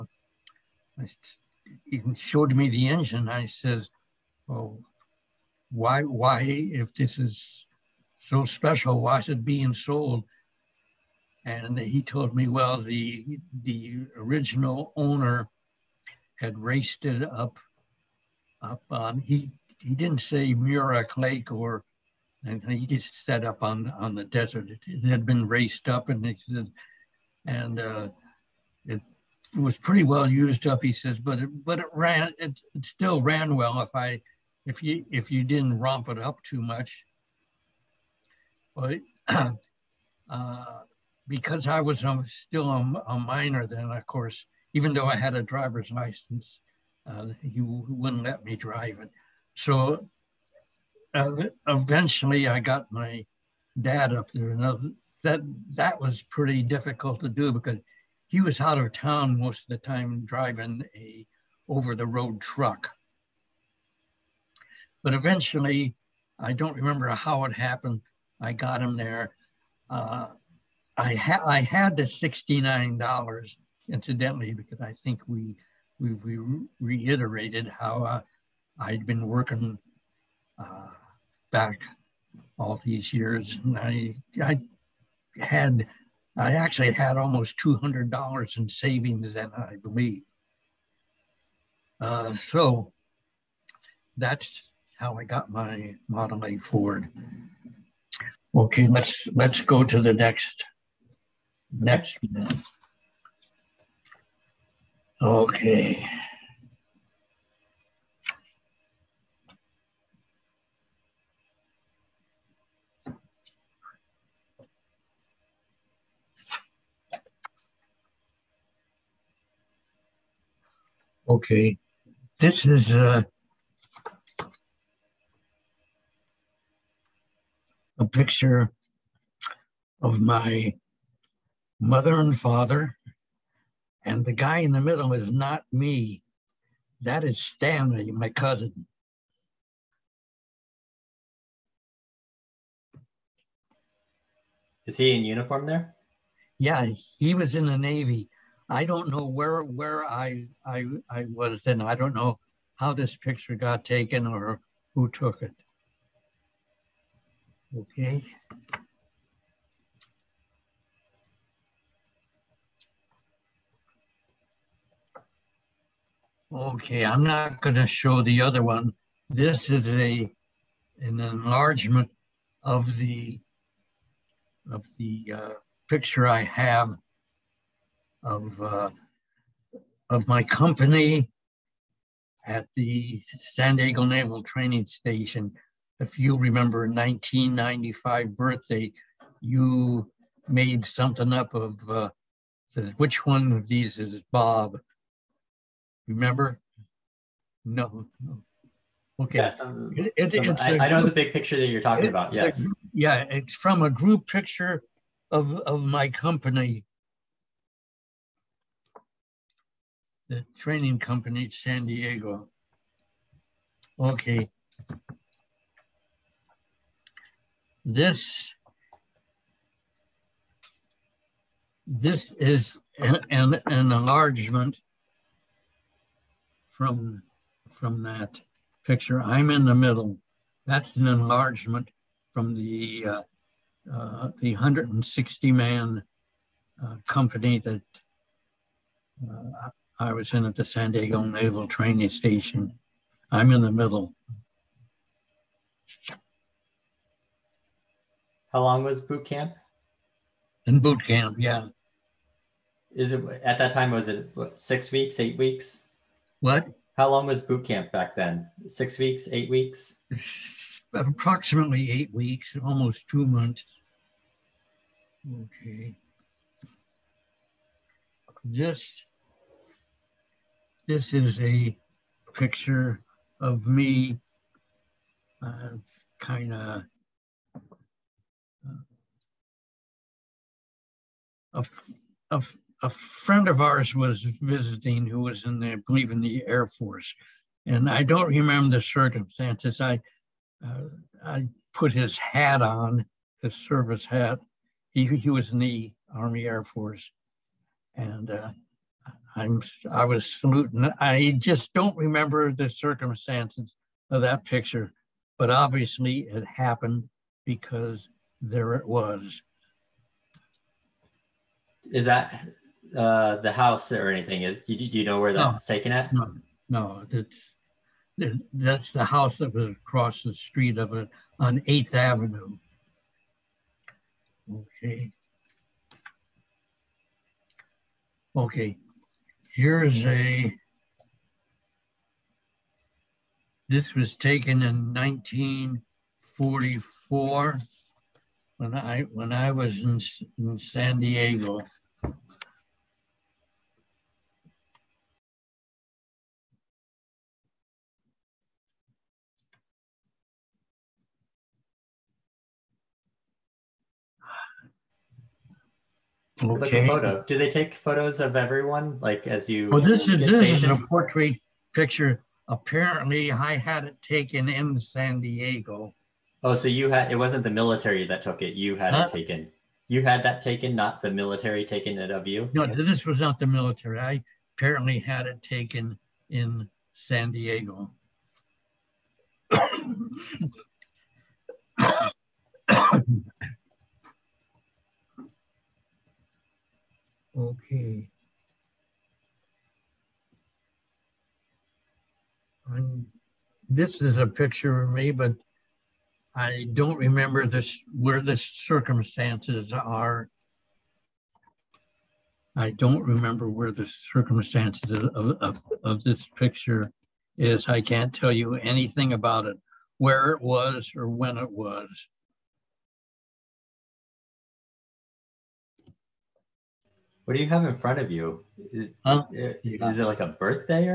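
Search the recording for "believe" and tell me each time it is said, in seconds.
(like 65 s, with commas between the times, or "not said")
89 s, 285 s.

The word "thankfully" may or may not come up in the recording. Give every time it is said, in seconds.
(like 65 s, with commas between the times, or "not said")
not said.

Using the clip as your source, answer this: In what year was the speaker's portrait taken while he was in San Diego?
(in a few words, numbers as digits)
1944.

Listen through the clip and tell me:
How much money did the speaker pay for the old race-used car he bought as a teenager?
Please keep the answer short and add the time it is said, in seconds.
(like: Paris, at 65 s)
$69, at 72 s.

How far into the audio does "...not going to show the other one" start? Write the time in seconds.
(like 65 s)
167 s.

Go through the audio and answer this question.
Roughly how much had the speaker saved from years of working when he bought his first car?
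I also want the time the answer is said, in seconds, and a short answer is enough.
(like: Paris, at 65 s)
$200, at 87 s.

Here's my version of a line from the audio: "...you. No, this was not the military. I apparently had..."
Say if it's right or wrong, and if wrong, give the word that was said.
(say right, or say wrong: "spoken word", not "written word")
right.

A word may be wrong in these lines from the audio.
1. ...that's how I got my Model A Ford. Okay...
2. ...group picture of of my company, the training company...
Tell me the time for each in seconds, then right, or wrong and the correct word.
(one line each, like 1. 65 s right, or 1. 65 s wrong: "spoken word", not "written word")
1. 94 s right
2. 203 s right.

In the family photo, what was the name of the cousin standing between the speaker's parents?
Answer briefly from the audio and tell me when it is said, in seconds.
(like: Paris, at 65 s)
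Stanley, at 137 s.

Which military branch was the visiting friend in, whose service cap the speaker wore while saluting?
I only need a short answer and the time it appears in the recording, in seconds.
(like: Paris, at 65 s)
Army Air Force, at 296 s.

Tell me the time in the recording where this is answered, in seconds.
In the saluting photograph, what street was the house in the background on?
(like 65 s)
321 s.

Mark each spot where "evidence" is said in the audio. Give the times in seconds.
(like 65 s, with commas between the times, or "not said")
not said.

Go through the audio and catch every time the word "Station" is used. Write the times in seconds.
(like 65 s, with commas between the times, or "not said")
184 s, 242 s.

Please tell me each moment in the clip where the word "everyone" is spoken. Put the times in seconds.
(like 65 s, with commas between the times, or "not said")
358 s.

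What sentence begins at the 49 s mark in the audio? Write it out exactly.
So uh, eventually I got my dad up there.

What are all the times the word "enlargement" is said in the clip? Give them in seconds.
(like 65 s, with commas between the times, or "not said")
171 s, 223 s, 231 s.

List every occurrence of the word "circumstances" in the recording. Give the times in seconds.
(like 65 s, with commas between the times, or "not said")
288 s, 302 s, 398 s, 403 s.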